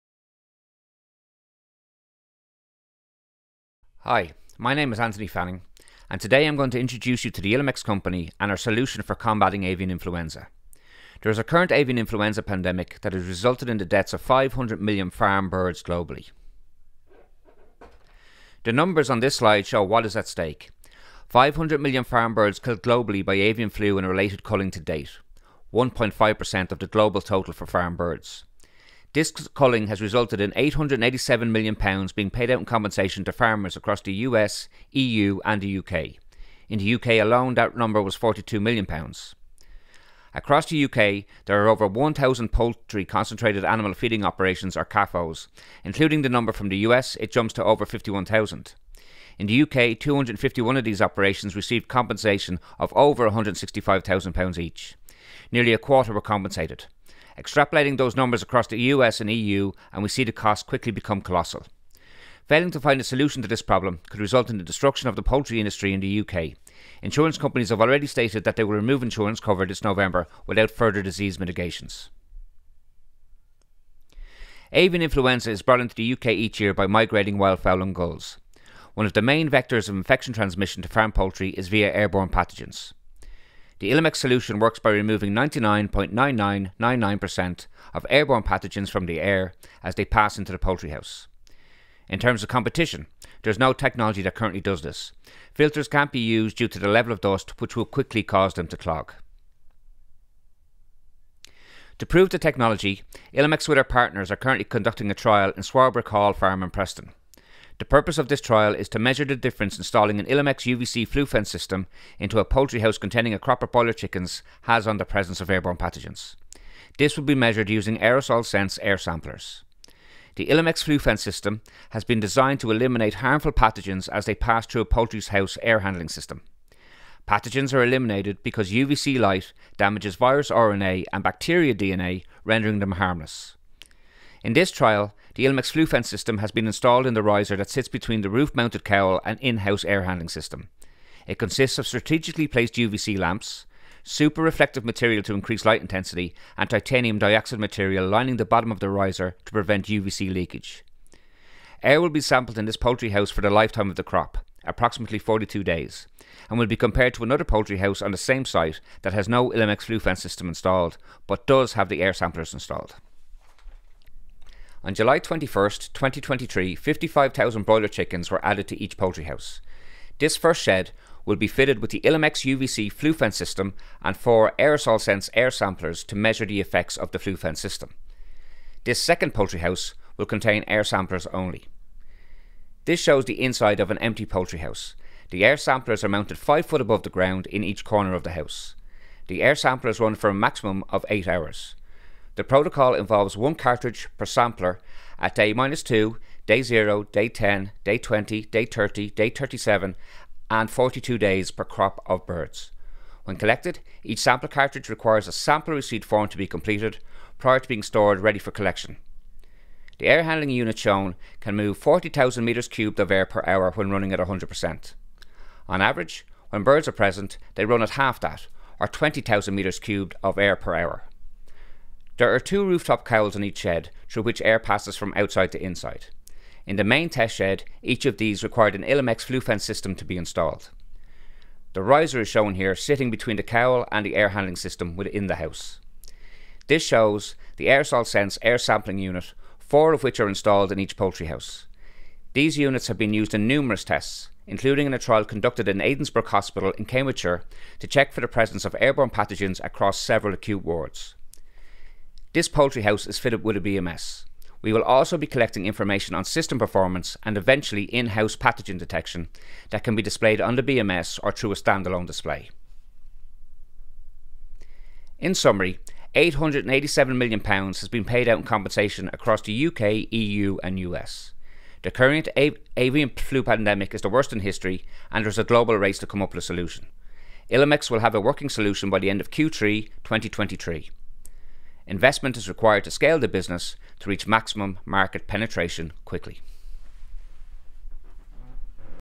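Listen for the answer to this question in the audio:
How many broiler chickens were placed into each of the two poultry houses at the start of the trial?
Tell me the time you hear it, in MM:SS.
02:46.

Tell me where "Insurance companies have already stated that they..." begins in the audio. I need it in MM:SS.
01:07.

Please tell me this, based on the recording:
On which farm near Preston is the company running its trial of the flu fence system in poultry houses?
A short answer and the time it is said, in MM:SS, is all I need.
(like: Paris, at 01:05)
Swarbrick Hall Farm, at 01:45.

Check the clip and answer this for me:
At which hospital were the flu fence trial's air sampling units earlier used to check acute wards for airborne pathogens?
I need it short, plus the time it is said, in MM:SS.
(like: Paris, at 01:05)
Addenbrooke's Hospital, at 04:05.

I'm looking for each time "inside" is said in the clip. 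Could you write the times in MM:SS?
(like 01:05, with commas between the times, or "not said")
03:03, 03:45.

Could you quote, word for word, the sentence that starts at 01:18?
One of the main vectors of infection transmission to farm poultry is via airborne pathogens.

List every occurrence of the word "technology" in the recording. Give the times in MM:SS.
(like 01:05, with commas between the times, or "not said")
01:33, 01:42.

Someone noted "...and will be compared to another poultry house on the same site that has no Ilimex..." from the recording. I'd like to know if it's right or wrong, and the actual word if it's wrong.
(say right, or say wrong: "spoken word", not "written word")
right.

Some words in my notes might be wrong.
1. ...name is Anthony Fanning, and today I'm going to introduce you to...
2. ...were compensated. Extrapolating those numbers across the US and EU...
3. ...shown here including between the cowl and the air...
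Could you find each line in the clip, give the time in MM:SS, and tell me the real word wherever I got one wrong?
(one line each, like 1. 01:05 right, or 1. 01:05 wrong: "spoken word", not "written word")
1. 00:04 right
2. 00:56 right
3. 03:52 wrong: "sitting", not "including".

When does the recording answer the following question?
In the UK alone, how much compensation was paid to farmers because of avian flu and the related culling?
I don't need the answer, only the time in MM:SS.
00:38.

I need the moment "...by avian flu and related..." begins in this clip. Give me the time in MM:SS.
00:23.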